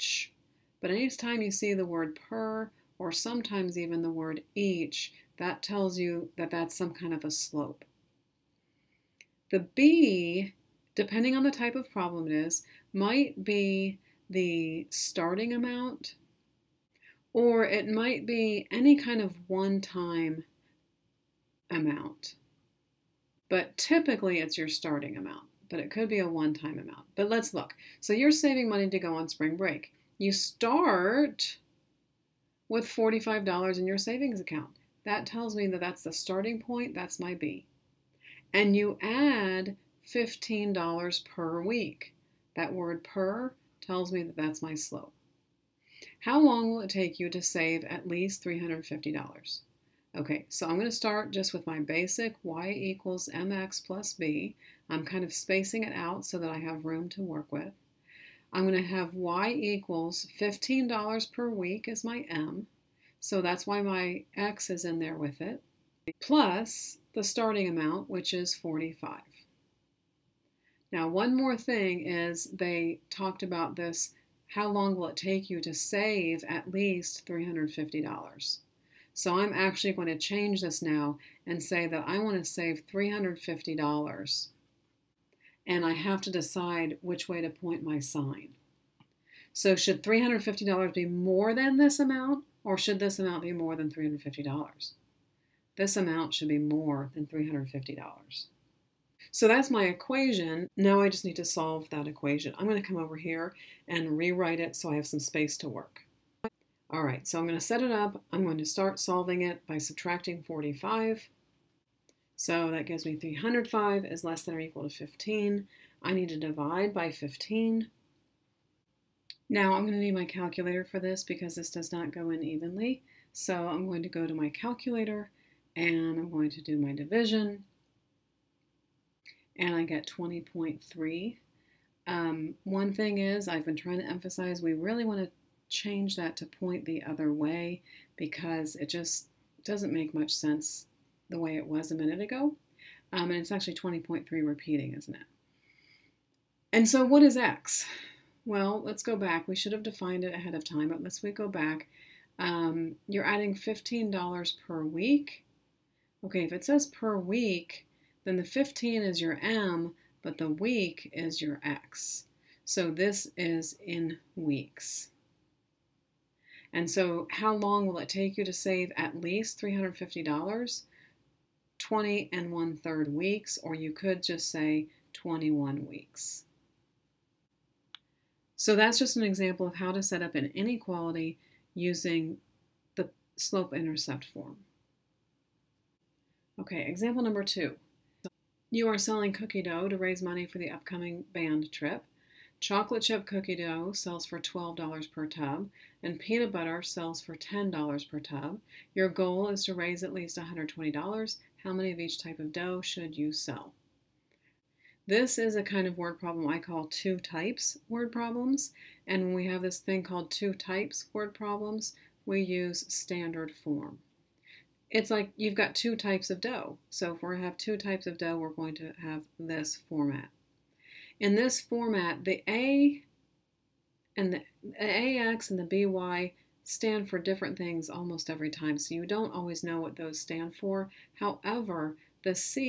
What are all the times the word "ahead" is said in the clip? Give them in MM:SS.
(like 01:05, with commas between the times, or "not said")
02:30.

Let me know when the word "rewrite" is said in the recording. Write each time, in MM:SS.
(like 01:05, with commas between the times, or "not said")
01:44.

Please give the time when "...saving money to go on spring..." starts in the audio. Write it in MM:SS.
00:28.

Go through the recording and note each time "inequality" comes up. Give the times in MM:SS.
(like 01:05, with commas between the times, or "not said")
03:00.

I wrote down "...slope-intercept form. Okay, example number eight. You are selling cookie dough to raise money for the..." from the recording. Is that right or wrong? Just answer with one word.
wrong.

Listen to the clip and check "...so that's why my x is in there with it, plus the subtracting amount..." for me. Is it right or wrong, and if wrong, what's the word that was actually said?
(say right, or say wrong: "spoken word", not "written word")
wrong: "starting", not "subtracting".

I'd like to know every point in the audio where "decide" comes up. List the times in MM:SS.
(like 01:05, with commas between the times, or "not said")
01:26.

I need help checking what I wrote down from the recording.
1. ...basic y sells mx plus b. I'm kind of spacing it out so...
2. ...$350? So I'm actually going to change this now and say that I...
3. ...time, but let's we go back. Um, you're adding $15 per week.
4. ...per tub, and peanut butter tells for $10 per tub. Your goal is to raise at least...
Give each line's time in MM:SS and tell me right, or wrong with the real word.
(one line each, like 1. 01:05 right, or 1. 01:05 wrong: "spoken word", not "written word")
1. 00:51 wrong: "equals", not "sells"
2. 01:17 right
3. 02:30 right
4. 03:15 wrong: "sells", not "tells".